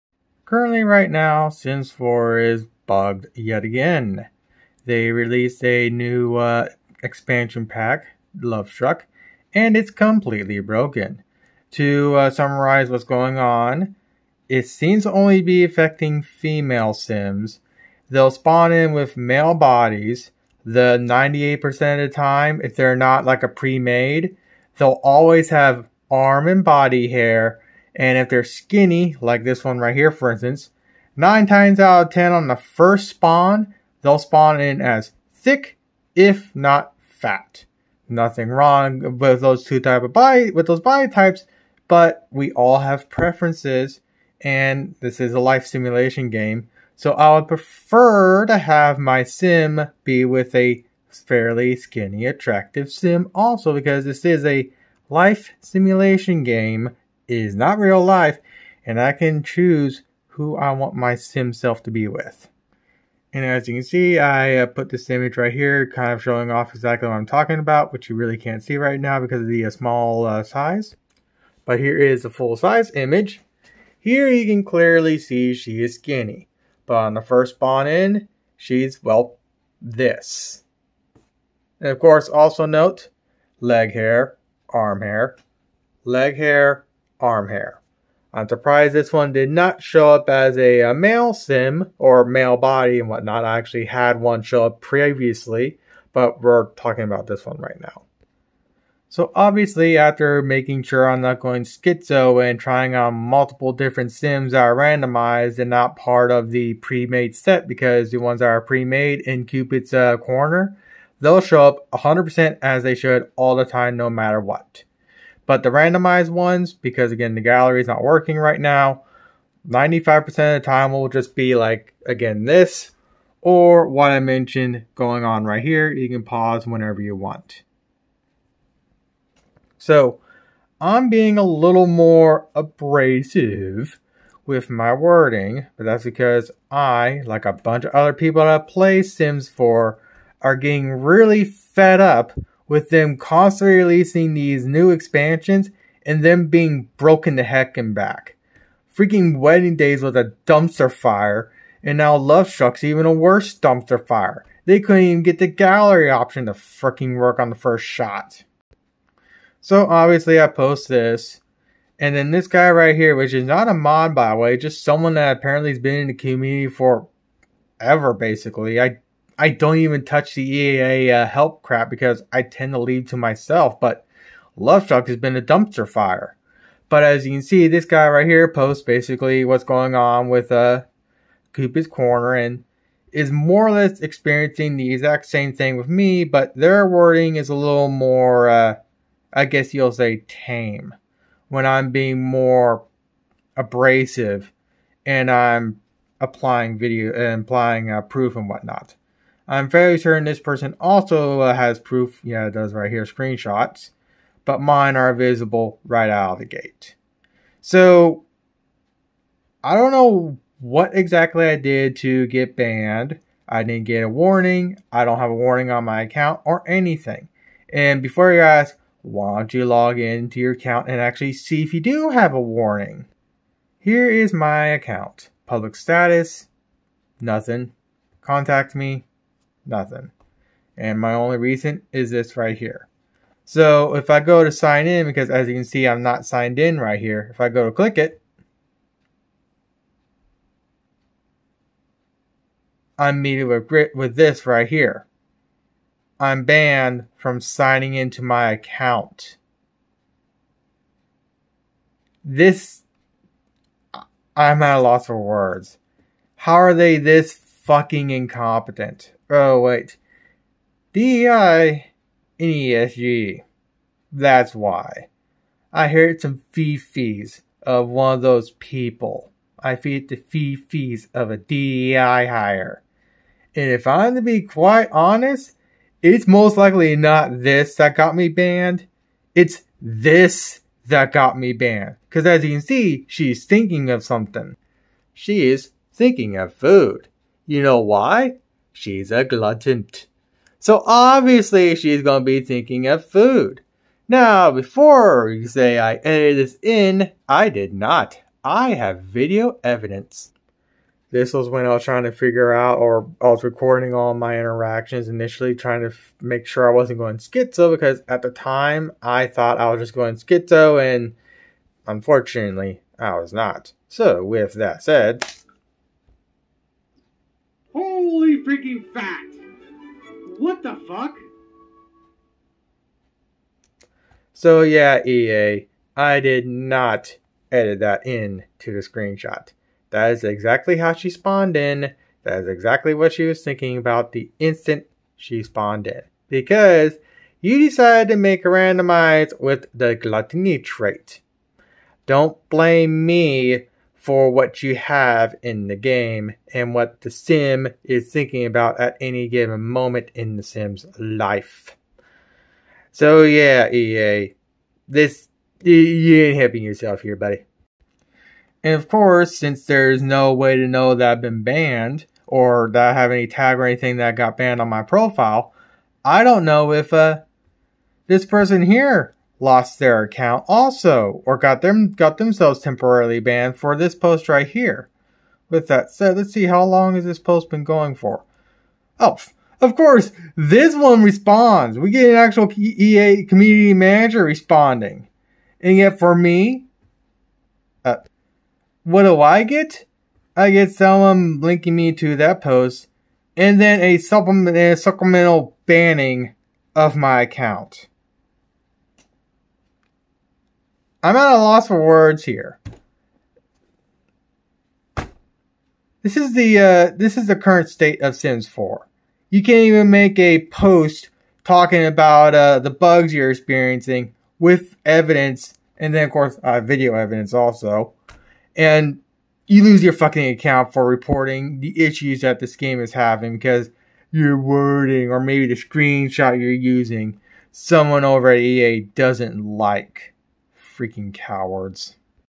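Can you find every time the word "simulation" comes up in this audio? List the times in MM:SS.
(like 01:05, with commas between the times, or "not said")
00:45, 00:55.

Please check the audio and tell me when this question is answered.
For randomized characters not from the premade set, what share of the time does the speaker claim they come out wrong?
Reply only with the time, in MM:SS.
01:59.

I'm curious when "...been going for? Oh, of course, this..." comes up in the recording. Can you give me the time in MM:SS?
06:17.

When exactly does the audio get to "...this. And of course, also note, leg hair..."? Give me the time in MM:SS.
01:19.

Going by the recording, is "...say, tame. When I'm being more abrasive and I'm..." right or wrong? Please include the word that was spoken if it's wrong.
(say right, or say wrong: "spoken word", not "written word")
right.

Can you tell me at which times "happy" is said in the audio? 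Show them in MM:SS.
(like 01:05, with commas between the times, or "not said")
not said.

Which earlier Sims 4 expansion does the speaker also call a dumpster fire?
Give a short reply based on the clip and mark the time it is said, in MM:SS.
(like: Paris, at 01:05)
Wedding Days, at 02:29.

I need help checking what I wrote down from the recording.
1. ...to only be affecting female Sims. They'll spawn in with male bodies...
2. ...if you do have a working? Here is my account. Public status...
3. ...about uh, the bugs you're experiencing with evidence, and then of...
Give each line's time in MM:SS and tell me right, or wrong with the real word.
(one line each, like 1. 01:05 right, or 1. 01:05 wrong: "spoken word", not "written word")
1. 00:15 right
2. 03:41 wrong: "warning", not "working"
3. 06:51 right.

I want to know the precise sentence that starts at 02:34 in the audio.
They couldn't even get the gallery option to freaking work on the first shot.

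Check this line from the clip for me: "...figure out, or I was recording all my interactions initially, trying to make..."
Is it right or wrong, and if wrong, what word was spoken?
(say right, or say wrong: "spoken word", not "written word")
right.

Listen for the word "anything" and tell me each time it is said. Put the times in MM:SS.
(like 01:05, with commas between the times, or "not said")
03:36, 06:03.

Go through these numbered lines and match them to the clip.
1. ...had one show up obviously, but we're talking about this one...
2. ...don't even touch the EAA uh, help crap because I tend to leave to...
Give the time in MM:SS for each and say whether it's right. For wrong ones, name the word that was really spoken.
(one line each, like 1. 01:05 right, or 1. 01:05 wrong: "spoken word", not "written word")
1. 01:33 wrong: "previously", not "obviously"
2. 02:49 right.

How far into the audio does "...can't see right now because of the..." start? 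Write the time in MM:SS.
01:08.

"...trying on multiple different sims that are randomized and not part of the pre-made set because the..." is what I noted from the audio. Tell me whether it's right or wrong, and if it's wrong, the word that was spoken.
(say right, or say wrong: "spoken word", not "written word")
right.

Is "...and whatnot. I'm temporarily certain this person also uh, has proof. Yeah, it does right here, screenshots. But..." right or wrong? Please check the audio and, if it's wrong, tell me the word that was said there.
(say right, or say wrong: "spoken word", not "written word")
wrong: "fairly", not "temporarily".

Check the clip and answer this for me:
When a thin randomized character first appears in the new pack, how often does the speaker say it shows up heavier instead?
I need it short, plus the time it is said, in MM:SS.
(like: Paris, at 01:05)
9 out of 10, at 00:31.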